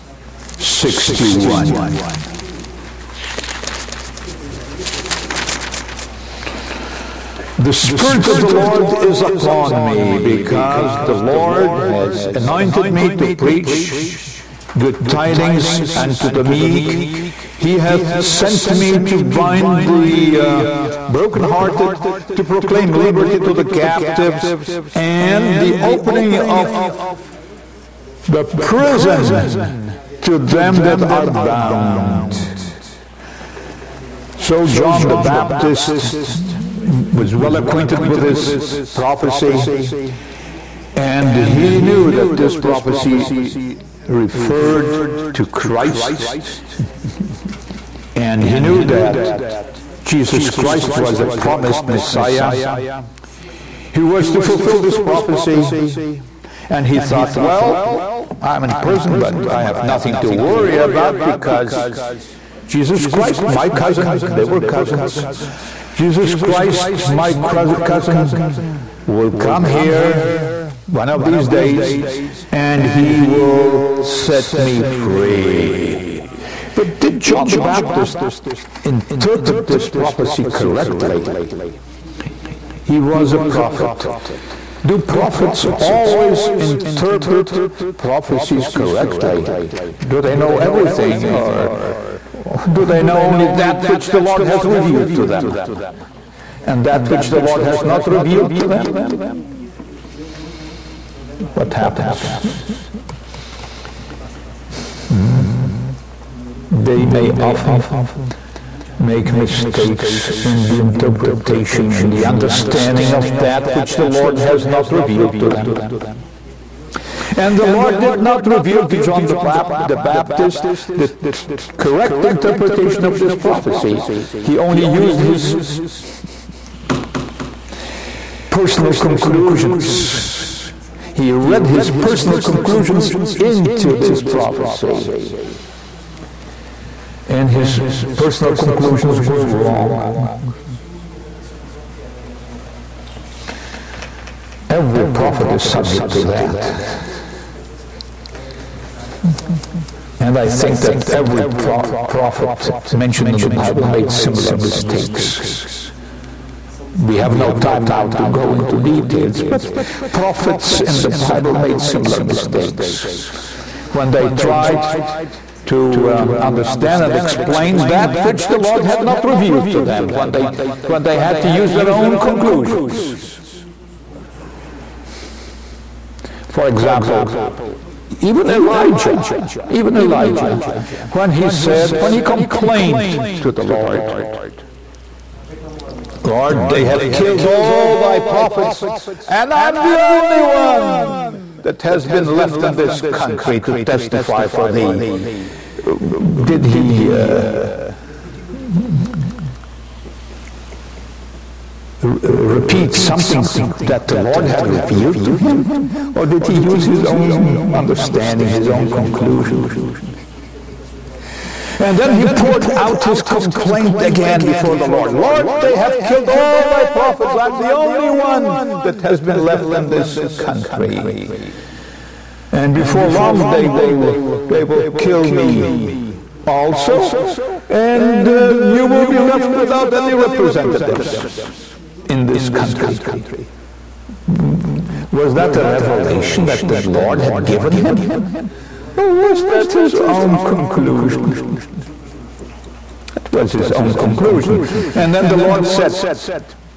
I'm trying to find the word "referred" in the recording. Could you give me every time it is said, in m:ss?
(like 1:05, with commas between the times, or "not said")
0:44.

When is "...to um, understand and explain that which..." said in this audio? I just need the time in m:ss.
2:45.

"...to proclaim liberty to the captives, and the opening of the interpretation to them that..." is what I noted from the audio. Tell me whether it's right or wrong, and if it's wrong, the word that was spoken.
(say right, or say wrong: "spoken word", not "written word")
wrong: "prison", not "interpretation".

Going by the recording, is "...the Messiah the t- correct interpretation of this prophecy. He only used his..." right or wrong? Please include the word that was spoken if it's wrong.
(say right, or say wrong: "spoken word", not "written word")
wrong: "Baptist", not "Messiah".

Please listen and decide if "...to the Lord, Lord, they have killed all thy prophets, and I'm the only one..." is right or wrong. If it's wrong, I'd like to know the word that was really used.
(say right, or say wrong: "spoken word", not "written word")
right.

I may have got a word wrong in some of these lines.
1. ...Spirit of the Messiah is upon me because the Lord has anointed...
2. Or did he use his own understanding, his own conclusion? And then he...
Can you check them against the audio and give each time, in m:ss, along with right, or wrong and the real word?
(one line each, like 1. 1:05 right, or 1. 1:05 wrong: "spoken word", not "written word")
1. 0:07 wrong: "Lord", not "Messiah"
2. 3:26 right.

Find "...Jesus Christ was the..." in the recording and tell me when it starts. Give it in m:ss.
0:50.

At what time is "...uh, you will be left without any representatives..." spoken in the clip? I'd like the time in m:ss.
3:48.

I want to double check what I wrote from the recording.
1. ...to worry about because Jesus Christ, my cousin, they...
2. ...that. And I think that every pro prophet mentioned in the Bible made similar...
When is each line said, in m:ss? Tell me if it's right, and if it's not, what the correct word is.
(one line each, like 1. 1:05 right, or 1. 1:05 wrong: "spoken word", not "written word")
1. 1:00 right
2. 2:26 right.